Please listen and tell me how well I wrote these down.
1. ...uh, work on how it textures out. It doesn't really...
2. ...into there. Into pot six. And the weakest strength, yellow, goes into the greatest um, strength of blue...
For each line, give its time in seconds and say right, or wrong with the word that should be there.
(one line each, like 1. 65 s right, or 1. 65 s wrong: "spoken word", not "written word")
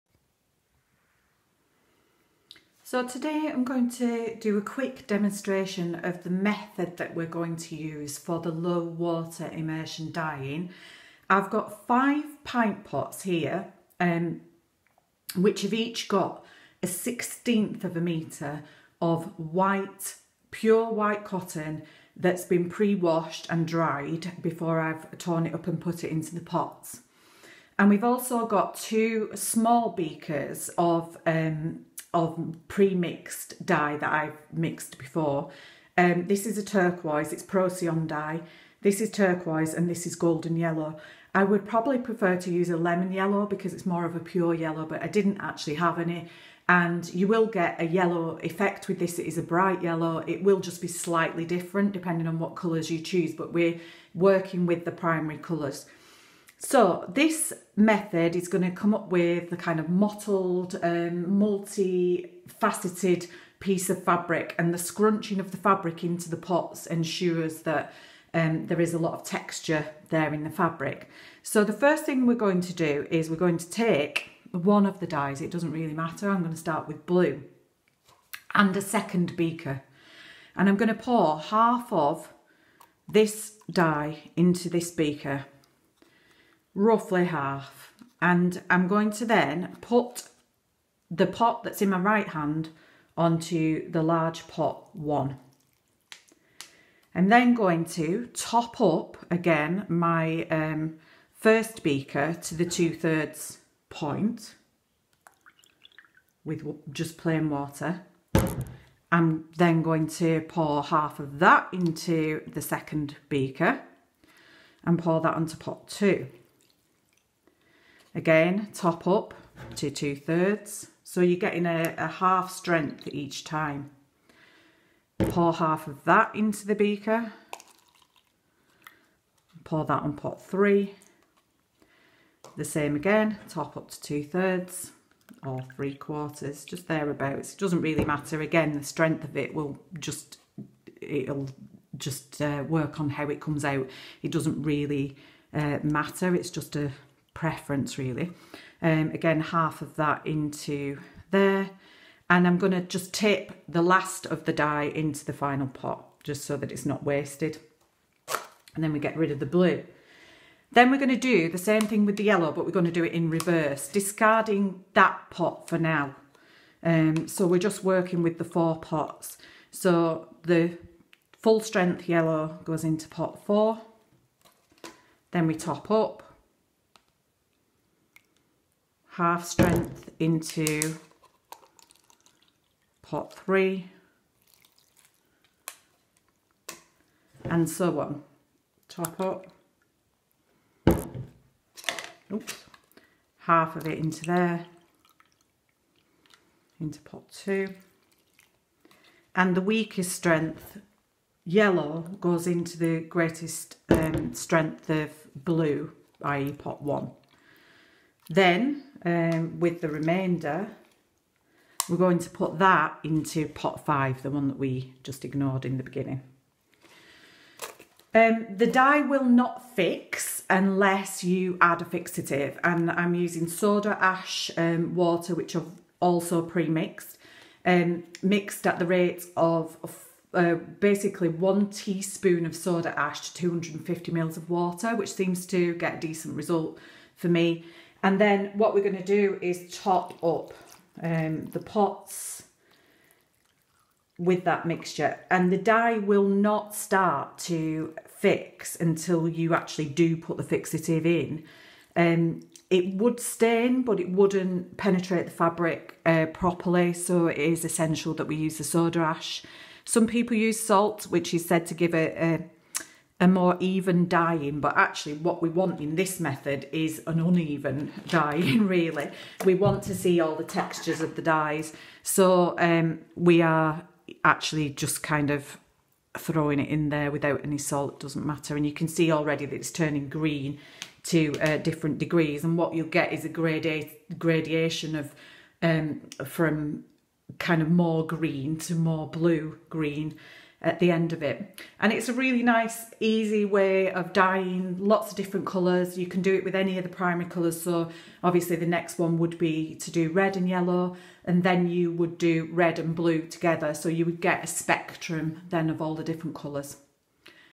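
1. 142 s wrong: "comes", not "textures"
2. 193 s wrong: "two", not "six".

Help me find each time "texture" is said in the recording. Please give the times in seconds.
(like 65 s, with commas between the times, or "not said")
69 s, 270 s.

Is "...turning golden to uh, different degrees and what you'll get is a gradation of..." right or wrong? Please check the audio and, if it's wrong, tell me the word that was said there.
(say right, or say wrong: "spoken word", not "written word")
wrong: "green", not "golden".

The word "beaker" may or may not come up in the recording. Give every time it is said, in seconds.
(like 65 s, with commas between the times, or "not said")
29 s, 79 s, 84 s, 101 s, 113 s, 126 s.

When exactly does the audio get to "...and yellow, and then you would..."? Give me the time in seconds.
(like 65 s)
300 s.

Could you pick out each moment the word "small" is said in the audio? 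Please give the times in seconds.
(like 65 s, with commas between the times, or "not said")
29 s.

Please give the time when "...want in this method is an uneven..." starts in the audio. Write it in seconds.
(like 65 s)
265 s.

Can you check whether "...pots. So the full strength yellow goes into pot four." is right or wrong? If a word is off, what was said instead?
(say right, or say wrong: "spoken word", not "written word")
right.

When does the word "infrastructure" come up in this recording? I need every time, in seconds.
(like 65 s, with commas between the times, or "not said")
not said.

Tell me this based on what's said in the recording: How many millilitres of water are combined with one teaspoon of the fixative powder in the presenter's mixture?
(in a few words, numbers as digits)
250.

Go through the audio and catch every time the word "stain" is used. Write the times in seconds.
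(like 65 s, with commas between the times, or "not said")
253 s.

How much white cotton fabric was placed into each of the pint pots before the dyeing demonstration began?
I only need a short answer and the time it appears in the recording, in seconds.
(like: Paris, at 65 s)
a sixteenth of a metre, at 16 s.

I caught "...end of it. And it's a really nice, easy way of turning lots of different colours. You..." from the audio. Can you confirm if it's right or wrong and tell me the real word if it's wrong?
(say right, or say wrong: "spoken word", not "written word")
wrong: "dyeing", not "turning".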